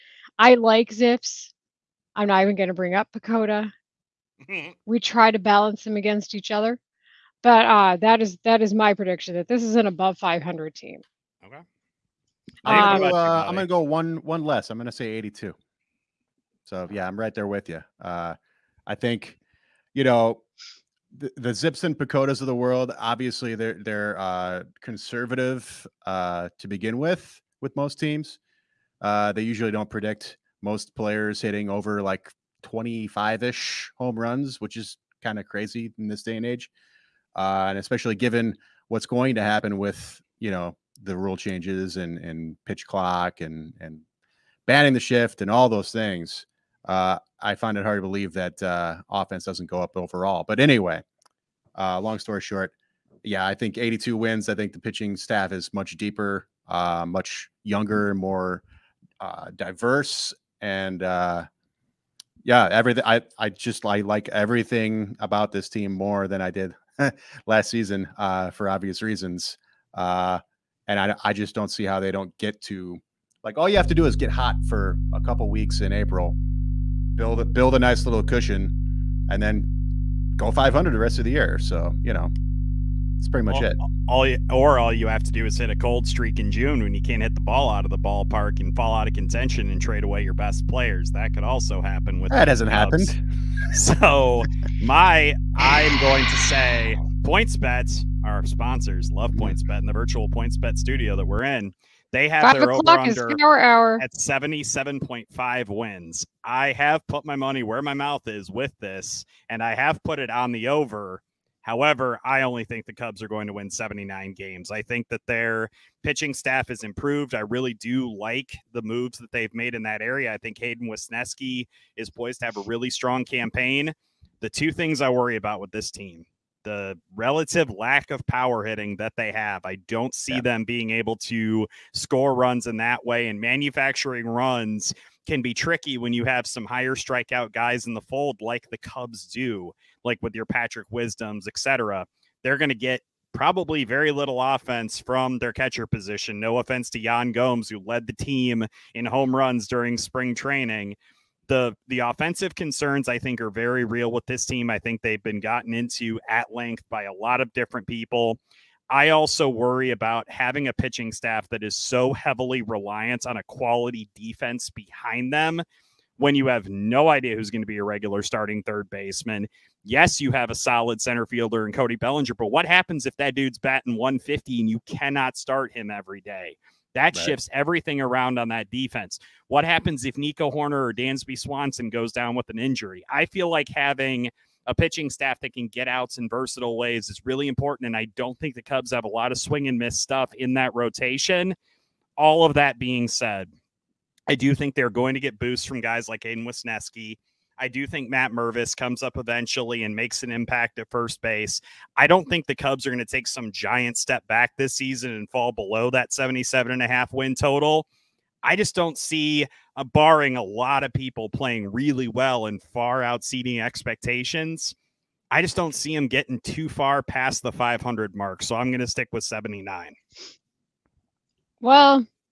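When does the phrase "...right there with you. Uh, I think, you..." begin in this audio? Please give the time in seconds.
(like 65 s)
17 s.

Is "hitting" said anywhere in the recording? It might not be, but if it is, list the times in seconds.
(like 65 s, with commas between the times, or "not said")
31 s, 128 s.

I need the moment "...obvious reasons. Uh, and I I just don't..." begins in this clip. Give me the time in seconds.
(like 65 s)
68 s.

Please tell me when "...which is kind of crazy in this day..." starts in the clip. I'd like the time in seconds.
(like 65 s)
34 s.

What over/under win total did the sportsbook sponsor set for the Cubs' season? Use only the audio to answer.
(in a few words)
77.5.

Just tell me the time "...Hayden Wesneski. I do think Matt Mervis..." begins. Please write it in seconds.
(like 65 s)
196 s.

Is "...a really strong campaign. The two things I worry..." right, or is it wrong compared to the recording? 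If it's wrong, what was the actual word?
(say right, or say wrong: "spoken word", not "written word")
right.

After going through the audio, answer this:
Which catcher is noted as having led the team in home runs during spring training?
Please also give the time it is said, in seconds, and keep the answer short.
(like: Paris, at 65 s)
Yan Gomes, at 146 s.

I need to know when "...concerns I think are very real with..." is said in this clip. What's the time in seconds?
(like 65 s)
152 s.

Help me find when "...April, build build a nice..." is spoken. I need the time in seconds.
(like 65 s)
75 s.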